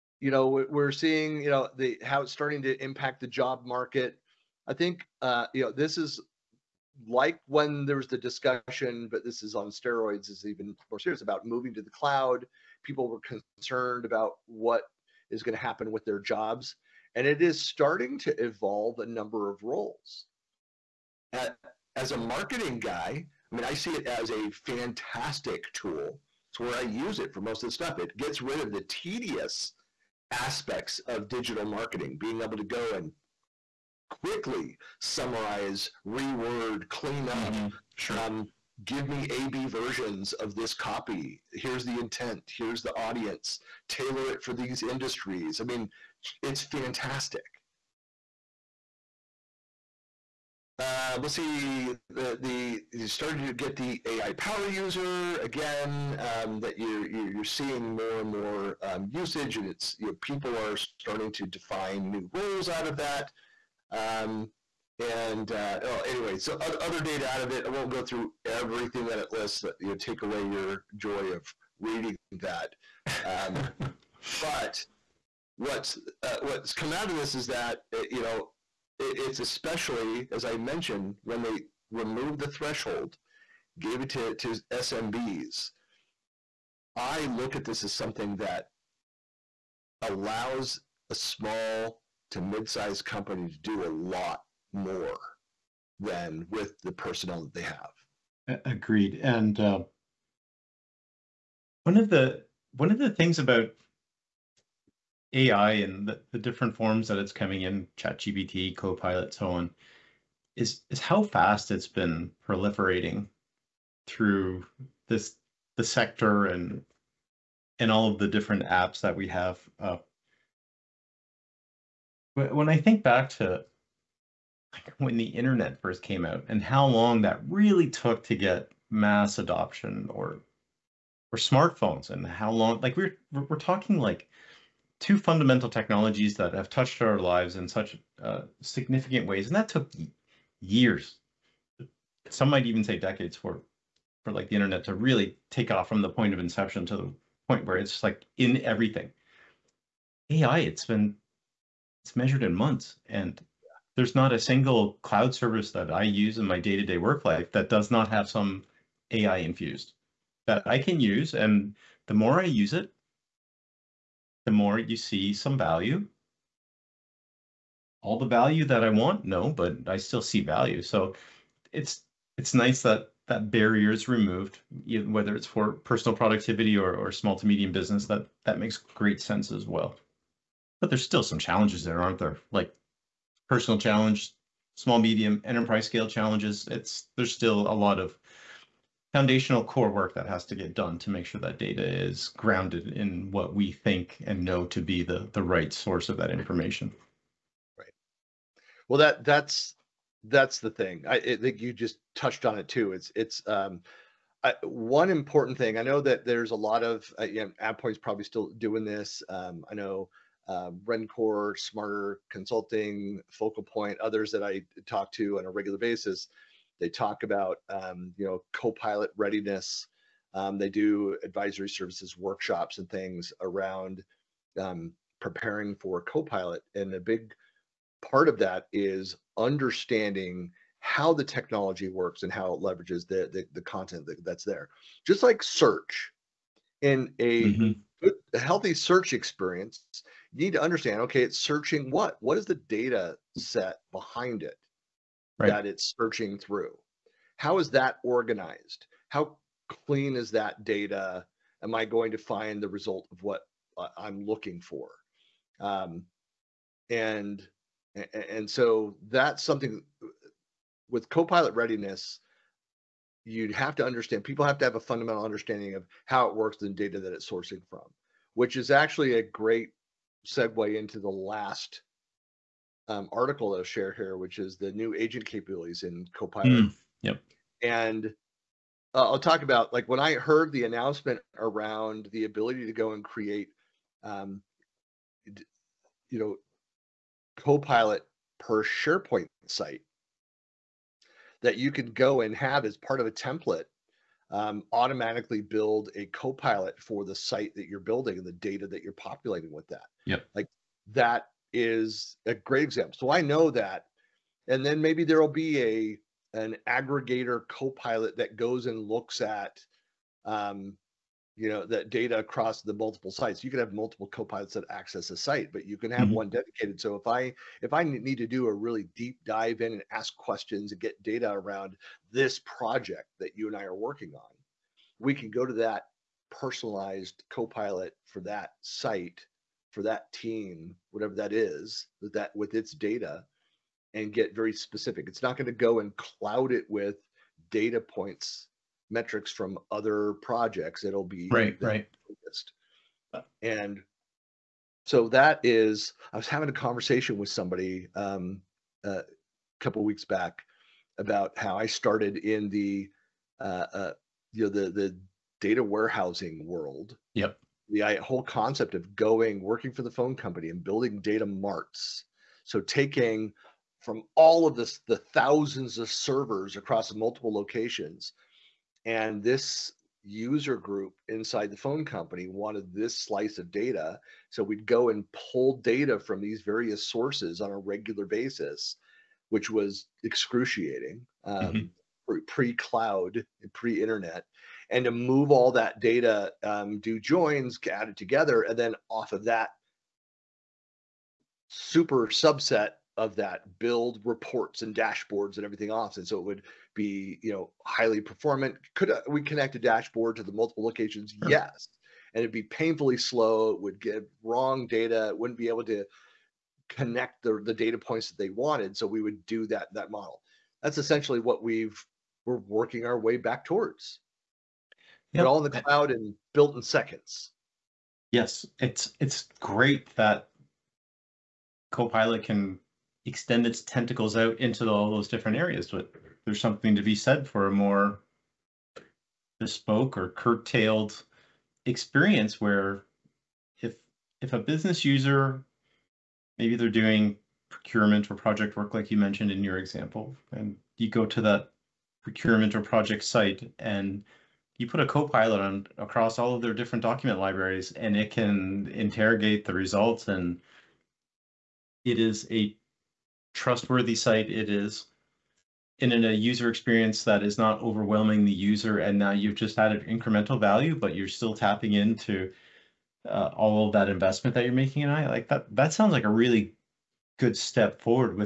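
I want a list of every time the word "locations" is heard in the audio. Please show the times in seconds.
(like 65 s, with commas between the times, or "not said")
367 s, 400 s.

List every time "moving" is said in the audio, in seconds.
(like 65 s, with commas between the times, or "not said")
11 s.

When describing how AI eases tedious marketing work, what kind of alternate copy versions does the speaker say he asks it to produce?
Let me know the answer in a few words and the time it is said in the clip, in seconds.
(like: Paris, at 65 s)
AB versions, at 39 s.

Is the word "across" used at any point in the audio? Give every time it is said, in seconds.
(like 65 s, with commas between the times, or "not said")
312 s, 366 s, 445 s.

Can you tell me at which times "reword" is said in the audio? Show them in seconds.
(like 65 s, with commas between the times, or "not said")
36 s.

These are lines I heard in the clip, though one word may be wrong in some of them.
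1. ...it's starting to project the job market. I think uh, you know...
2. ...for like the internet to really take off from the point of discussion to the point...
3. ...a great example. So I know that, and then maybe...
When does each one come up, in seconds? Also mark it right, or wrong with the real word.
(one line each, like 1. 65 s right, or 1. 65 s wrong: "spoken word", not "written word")
1. 2 s wrong: "impact", not "project"
2. 144 s wrong: "inception", not "discussion"
3. 302 s right.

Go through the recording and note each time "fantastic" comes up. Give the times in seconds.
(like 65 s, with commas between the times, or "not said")
24 s, 46 s.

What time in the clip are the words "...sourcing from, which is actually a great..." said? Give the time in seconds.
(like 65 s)
267 s.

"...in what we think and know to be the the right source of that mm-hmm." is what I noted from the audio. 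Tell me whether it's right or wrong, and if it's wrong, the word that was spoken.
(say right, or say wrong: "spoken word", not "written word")
right.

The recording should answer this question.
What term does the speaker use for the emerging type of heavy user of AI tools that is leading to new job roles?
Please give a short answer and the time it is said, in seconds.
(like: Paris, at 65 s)
AI power user, at 54 s.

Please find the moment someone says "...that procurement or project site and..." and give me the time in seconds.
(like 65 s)
441 s.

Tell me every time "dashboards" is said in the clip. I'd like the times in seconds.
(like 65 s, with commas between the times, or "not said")
394 s, 399 s.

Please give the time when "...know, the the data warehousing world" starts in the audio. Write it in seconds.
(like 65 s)
354 s.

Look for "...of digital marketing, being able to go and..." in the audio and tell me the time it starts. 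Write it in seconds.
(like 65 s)
31 s.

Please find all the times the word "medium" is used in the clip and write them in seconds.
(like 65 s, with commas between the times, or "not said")
177 s, 184 s.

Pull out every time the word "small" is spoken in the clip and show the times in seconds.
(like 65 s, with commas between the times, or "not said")
91 s, 177 s, 184 s.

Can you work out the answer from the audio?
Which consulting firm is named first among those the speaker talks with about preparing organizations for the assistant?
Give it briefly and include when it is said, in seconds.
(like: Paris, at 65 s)
Rencore, at 210 s.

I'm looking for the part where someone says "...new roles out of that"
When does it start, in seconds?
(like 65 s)
62 s.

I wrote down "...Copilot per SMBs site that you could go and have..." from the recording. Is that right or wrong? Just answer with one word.
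wrong.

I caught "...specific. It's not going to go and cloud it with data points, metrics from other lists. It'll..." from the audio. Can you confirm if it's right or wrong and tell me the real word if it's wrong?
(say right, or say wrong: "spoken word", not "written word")
wrong: "projects", not "lists".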